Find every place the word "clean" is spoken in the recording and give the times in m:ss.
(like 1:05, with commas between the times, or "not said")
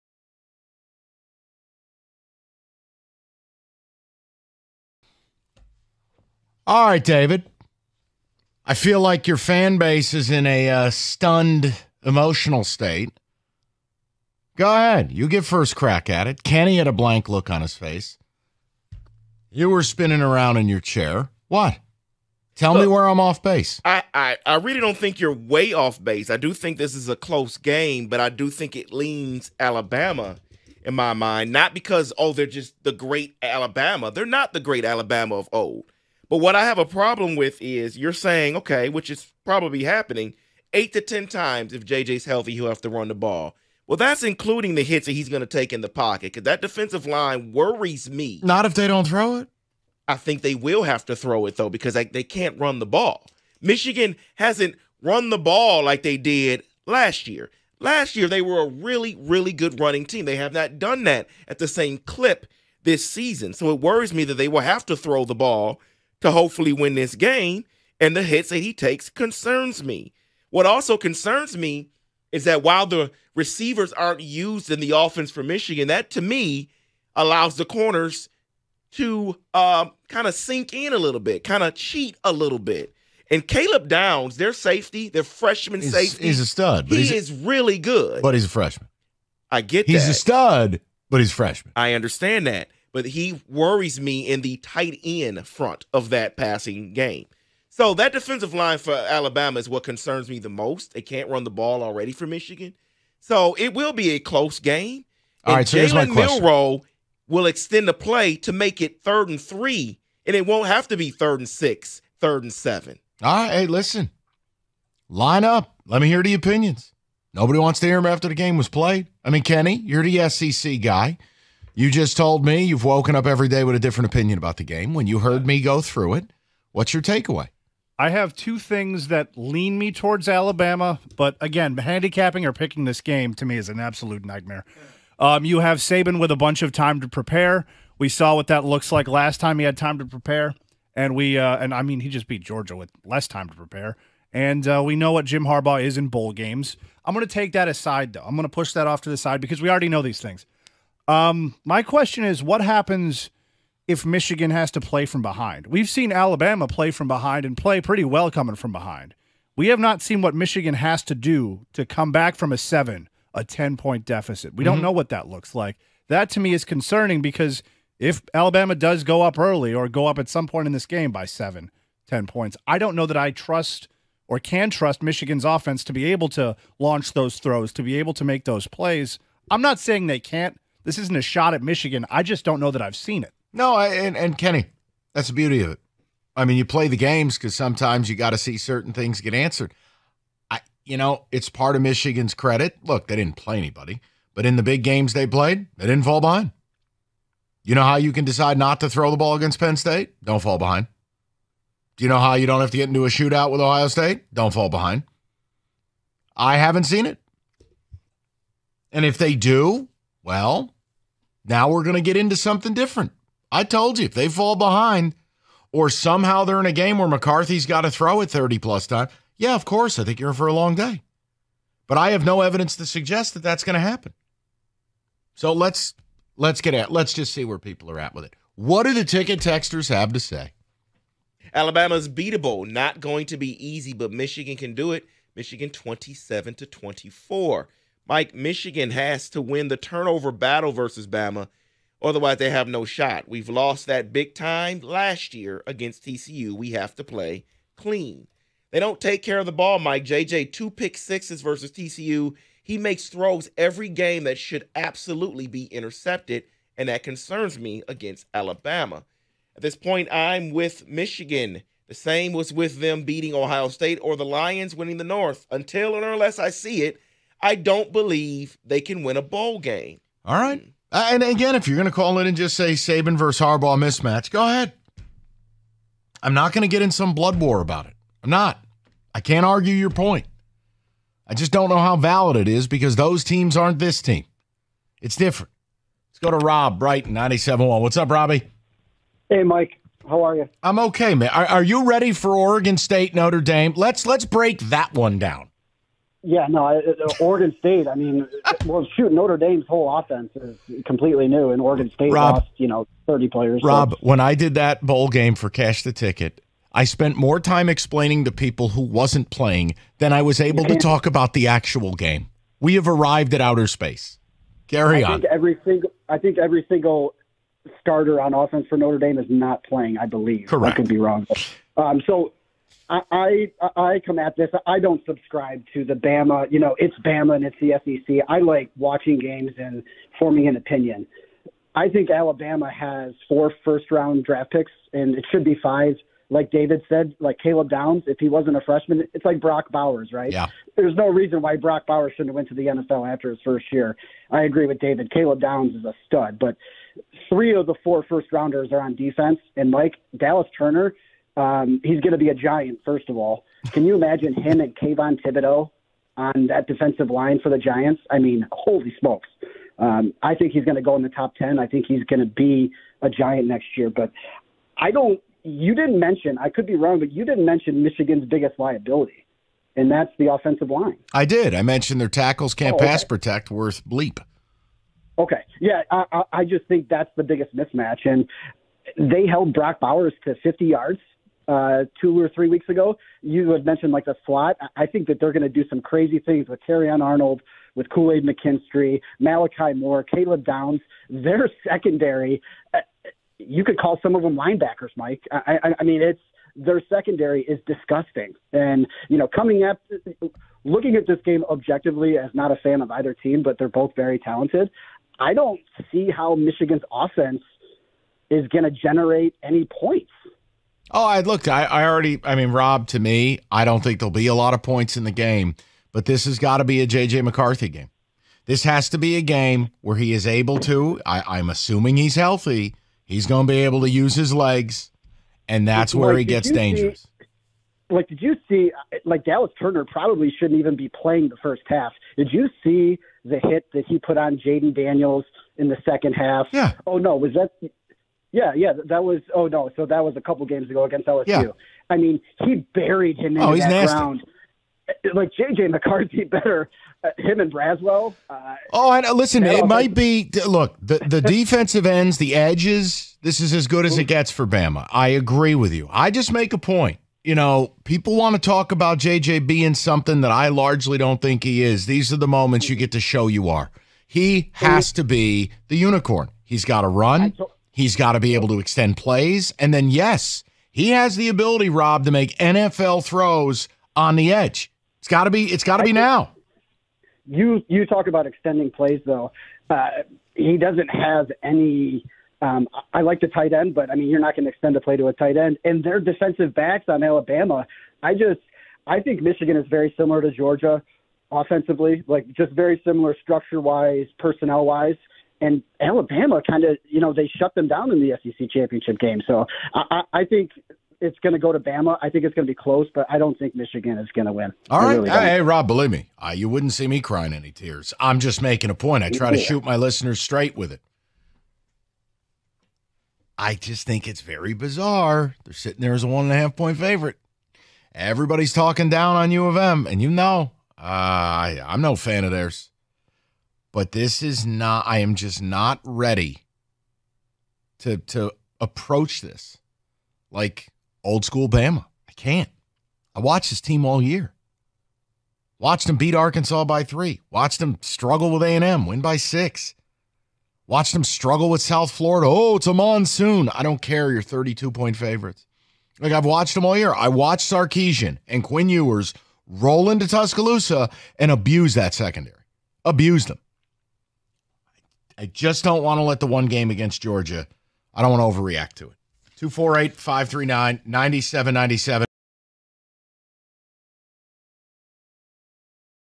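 4:07.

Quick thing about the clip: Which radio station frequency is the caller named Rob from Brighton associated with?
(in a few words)
97.1.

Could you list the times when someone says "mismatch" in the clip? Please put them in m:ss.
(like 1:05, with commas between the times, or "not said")
4:33, 6:17.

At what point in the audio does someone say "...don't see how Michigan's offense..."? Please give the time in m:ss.
6:45.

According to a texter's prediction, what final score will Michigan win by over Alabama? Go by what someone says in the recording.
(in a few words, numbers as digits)
27 to 24.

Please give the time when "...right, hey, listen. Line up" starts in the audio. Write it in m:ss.
1:53.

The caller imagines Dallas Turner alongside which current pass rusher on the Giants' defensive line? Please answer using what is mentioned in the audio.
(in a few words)
Kayvon Thibodeaux.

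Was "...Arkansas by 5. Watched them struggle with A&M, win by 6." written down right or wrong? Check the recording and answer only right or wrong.
wrong.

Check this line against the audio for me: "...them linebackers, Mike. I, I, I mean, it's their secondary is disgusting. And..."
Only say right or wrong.
right.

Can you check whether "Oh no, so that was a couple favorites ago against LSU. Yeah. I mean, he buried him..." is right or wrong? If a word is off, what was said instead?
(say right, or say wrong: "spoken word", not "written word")
wrong: "games", not "favorites".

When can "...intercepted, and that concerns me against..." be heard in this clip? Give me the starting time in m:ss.
4:15.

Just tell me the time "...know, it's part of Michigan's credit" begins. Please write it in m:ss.
3:10.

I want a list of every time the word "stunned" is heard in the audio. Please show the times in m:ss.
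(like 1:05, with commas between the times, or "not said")
0:10.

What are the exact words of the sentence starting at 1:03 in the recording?
So it worries me that they will have to throw the ball to hopefully win this game.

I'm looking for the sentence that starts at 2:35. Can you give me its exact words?
We've seen Alabama play from behind and play pretty well coming from behind.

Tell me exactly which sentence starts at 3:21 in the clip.
Do you know how you don't have to get into a shootout with Ohio State?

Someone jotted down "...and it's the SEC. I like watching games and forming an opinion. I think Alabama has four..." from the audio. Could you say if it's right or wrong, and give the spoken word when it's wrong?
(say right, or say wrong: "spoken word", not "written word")
right.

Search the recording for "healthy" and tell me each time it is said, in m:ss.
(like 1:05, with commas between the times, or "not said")
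0:42, 7:02.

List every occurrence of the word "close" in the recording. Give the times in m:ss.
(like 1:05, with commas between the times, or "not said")
0:27, 1:44, 8:22.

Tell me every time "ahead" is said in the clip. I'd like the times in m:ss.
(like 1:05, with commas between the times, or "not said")
0:14, 4:34.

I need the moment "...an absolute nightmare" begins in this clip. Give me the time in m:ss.
2:13.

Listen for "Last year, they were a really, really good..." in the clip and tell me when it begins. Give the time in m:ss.
0:57.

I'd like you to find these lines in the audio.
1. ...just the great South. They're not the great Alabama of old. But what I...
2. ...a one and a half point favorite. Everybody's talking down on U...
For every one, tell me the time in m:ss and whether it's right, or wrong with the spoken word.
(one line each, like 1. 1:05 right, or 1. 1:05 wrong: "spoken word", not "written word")
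1. 0:32 wrong: "Alabama", not "South"
2. 8:36 right.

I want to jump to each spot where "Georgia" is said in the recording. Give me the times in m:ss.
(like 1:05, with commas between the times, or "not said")
2:22, 8:10, 9:17.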